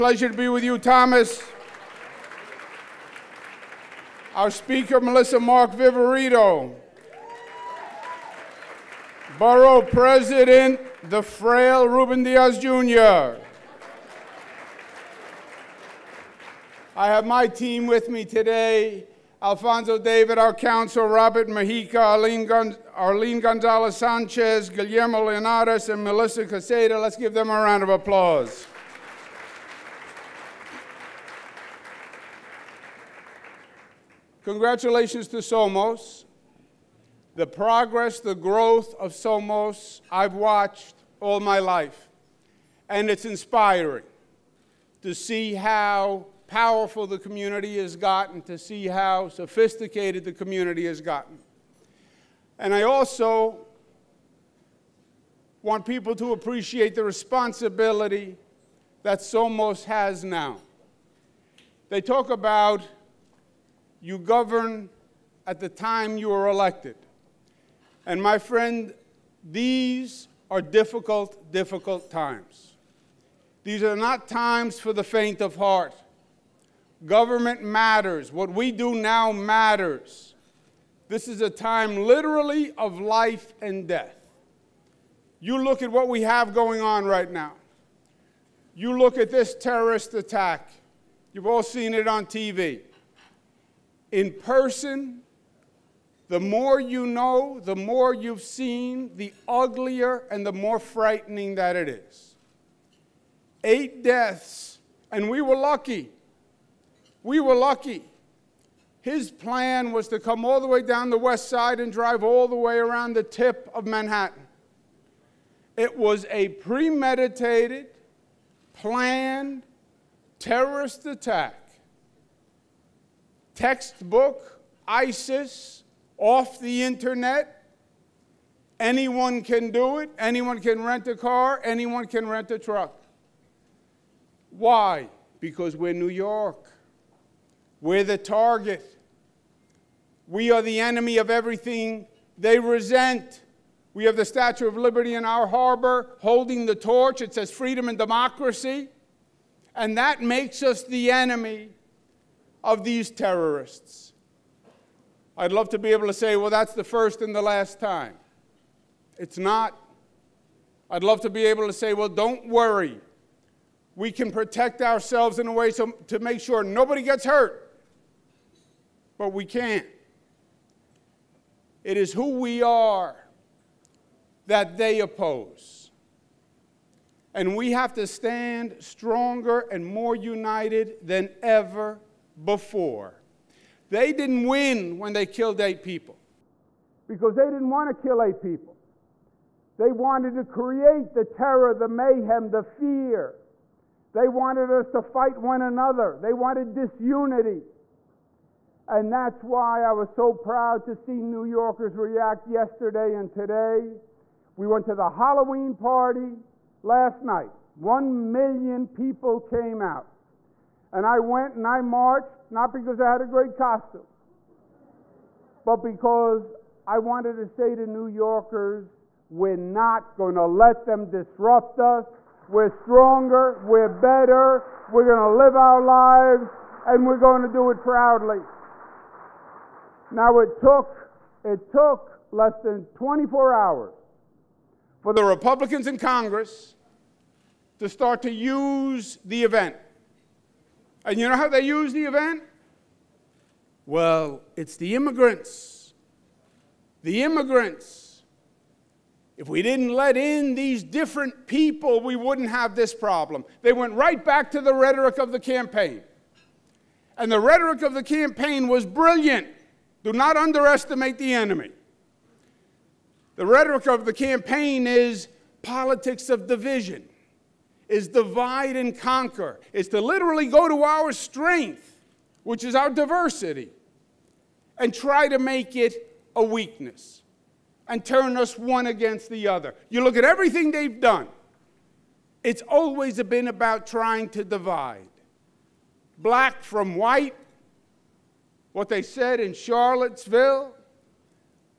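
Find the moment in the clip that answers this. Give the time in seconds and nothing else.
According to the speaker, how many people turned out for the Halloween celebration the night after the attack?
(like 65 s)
207 s.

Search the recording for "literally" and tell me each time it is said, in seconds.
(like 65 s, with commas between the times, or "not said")
81 s, 270 s.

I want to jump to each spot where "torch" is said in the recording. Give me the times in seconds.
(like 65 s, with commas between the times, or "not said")
146 s.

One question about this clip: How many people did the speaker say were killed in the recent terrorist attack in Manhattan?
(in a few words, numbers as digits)
8.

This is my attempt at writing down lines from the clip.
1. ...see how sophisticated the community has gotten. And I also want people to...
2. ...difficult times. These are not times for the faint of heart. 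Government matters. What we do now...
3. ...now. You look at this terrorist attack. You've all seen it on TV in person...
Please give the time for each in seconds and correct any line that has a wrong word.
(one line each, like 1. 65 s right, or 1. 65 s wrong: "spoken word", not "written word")
1. 48 s right
2. 71 s right
3. 87 s right.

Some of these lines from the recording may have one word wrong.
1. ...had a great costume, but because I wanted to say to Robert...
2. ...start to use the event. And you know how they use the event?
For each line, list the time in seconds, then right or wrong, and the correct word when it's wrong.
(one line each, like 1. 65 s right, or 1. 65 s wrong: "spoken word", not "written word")
1. 213 s wrong: "New", not "Robert"
2. 237 s right.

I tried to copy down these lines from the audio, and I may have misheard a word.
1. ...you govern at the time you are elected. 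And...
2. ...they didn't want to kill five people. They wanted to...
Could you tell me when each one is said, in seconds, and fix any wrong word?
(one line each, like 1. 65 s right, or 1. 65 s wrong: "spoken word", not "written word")
1. 64 s right
2. 187 s wrong: "eight", not "five".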